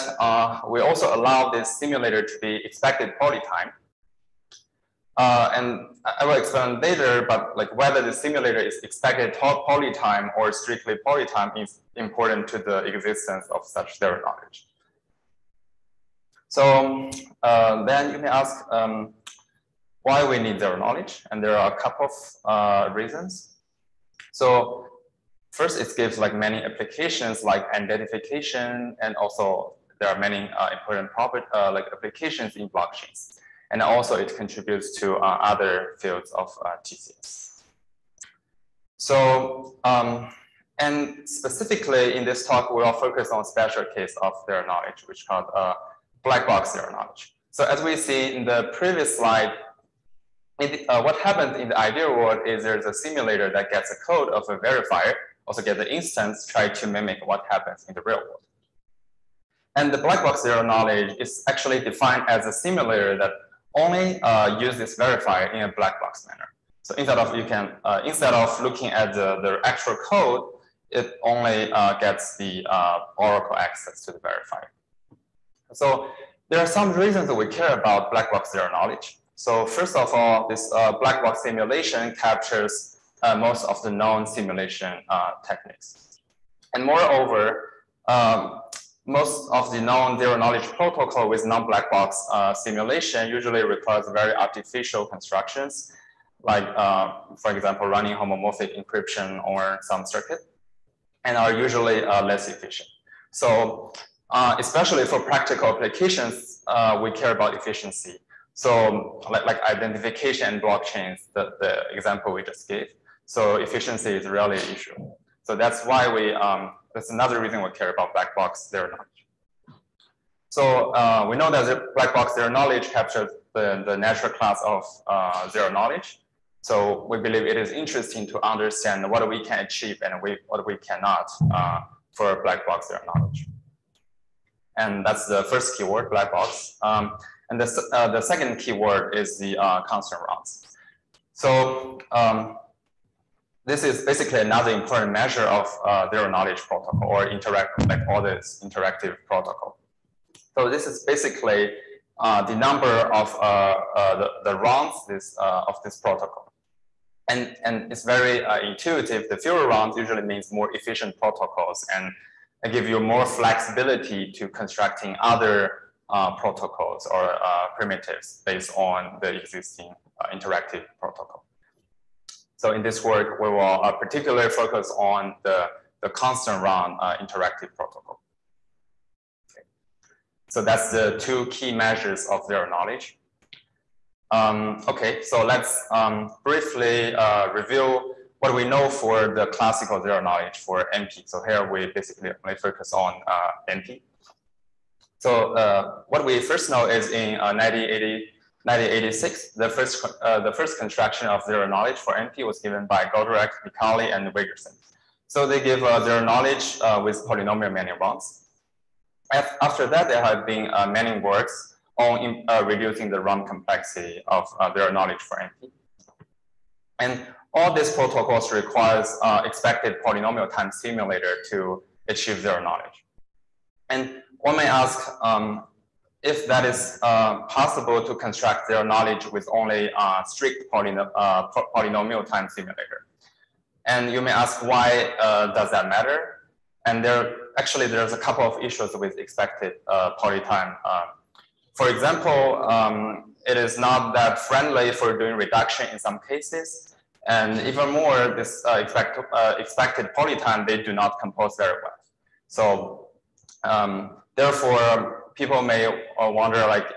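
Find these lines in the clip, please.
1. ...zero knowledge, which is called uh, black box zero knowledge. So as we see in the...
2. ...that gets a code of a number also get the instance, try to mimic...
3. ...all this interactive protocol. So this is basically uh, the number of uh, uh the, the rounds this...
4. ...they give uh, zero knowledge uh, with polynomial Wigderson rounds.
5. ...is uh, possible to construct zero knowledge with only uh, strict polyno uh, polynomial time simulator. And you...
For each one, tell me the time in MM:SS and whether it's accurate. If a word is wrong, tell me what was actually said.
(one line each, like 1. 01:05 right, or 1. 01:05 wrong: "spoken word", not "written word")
1. 00:44 right
2. 00:53 wrong: "verifier", not "number"
3. 02:28 right
4. 03:25 wrong: "Manning", not "Wigderson"
5. 03:46 right.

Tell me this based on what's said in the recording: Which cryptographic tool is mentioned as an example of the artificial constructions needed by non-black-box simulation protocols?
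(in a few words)
homomorphic encryption.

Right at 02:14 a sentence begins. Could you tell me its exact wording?
And that's the first keyword, black box.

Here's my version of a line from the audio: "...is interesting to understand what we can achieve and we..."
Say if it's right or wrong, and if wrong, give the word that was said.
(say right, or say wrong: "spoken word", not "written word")
right.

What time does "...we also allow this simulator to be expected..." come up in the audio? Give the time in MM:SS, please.
00:00.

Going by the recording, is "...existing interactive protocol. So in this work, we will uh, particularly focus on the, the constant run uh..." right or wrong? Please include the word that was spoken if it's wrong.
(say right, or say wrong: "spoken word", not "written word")
right.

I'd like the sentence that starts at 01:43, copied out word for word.
So uh, especially for practical applications, we care about efficiency.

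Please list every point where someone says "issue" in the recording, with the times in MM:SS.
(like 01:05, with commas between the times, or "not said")
01:54, 03:58.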